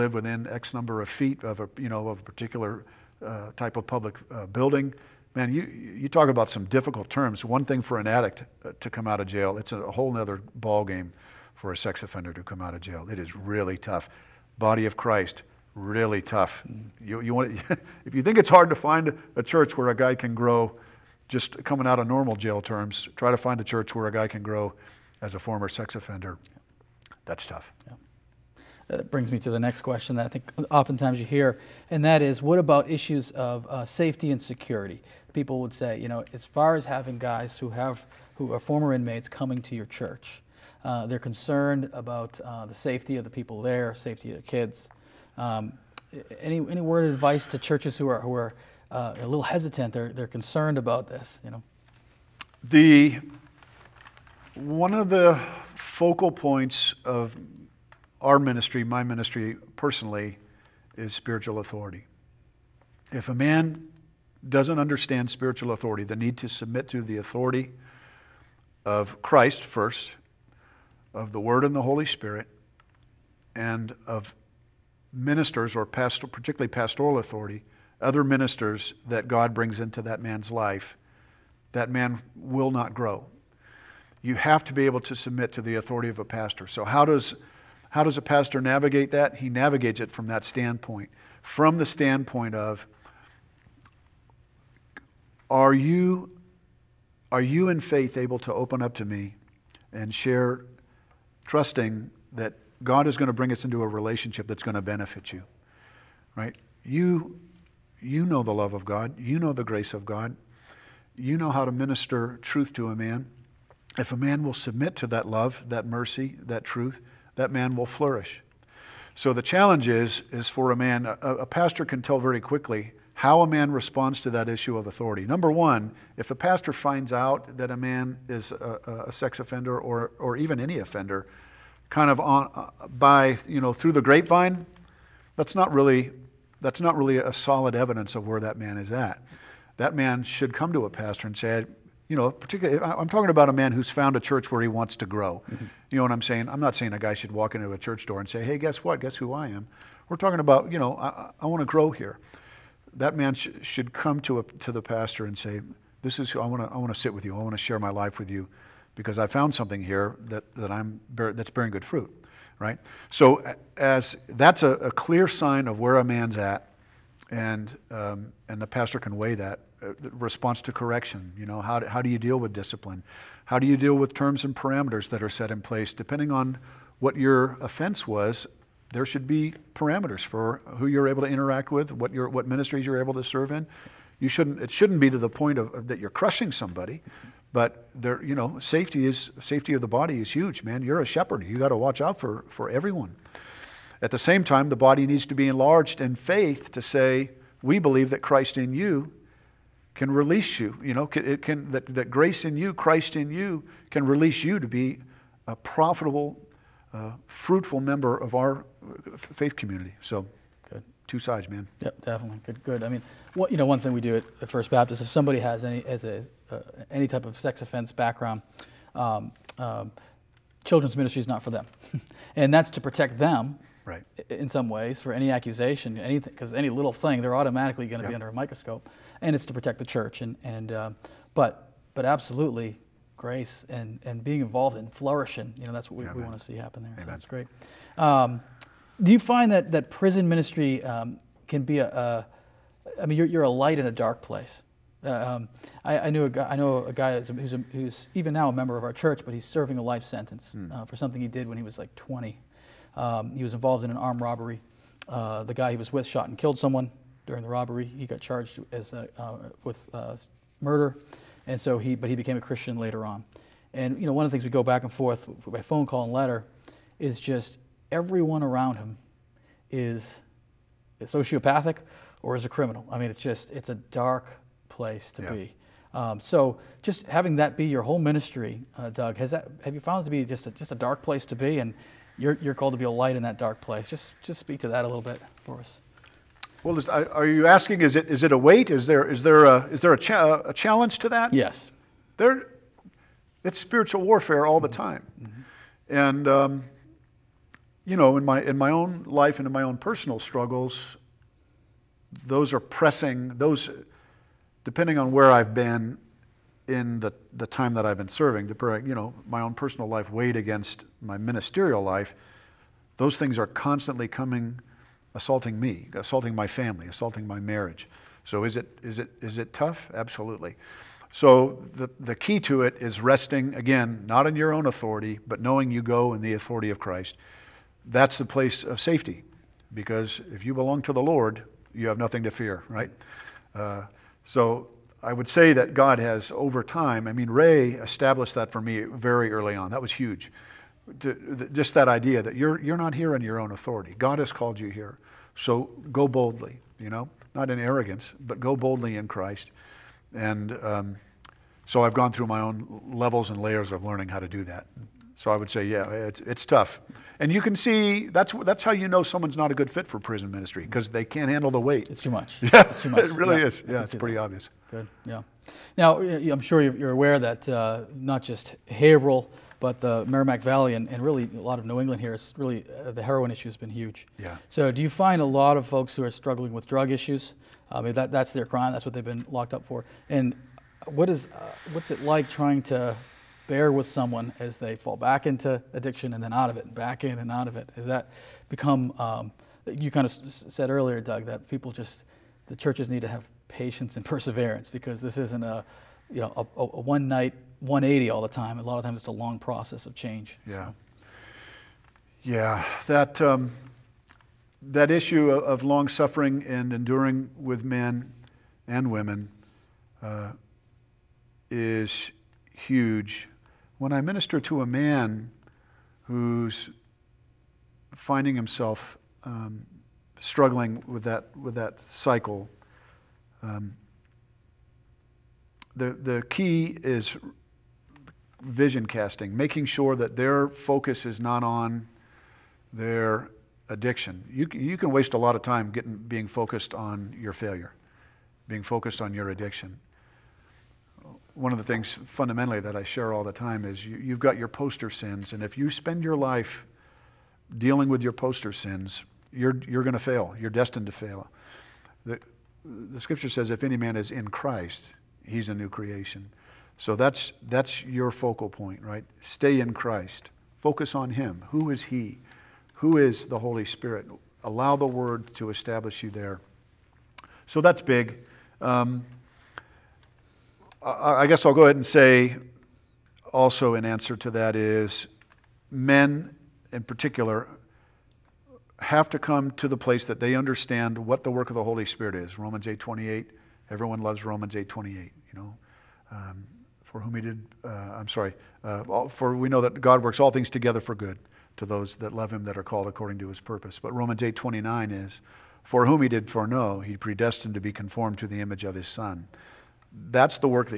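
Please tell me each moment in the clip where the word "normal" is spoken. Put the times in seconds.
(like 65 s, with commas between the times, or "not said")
22 s.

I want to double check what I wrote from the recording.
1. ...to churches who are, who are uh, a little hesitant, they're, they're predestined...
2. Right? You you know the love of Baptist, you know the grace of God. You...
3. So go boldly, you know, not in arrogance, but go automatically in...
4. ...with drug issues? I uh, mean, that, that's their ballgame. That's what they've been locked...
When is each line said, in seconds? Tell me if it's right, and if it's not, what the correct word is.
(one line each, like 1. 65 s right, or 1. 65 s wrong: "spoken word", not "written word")
1. 47 s wrong: "concerned", not "predestined"
2. 106 s wrong: "God", not "Baptist"
3. 345 s wrong: "boldly", not "automatically"
4. 376 s wrong: "crime", not "ballgame".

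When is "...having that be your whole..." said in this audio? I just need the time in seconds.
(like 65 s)
277 s.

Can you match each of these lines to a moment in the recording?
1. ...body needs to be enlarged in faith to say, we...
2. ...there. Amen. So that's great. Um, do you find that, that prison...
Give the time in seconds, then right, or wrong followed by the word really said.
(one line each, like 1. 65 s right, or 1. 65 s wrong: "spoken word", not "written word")
1. 194 s right
2. 236 s right.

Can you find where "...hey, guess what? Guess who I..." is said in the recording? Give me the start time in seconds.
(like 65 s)
148 s.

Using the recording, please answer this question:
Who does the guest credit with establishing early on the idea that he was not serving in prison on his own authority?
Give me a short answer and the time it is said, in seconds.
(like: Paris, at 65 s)
Ray, at 337 s.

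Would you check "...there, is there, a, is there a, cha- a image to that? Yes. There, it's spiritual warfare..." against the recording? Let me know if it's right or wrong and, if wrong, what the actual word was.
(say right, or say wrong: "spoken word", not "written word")
wrong: "challenge", not "image".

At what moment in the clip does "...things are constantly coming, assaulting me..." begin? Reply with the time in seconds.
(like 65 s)
313 s.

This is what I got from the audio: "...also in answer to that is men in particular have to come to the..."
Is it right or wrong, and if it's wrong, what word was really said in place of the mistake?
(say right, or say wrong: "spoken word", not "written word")
right.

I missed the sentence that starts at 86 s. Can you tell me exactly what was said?
So how does how does a pastor navigate that?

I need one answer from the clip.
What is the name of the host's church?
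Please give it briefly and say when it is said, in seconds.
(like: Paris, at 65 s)
First Baptist, at 214 s.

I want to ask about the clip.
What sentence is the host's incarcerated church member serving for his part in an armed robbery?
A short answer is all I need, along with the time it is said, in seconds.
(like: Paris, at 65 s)
life sentence, at 249 s.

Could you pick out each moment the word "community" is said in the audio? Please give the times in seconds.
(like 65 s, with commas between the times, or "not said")
209 s.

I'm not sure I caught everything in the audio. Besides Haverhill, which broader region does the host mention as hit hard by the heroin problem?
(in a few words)
Merrimack Valley.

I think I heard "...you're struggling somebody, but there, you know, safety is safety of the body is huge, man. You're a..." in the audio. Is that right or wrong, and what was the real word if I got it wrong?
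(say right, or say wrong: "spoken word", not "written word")
wrong: "crushing", not "struggling".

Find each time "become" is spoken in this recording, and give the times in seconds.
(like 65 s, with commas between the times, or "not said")
388 s.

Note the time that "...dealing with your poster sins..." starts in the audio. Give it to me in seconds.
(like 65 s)
447 s.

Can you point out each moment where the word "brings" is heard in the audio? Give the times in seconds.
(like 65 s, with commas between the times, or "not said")
29 s, 79 s, 103 s.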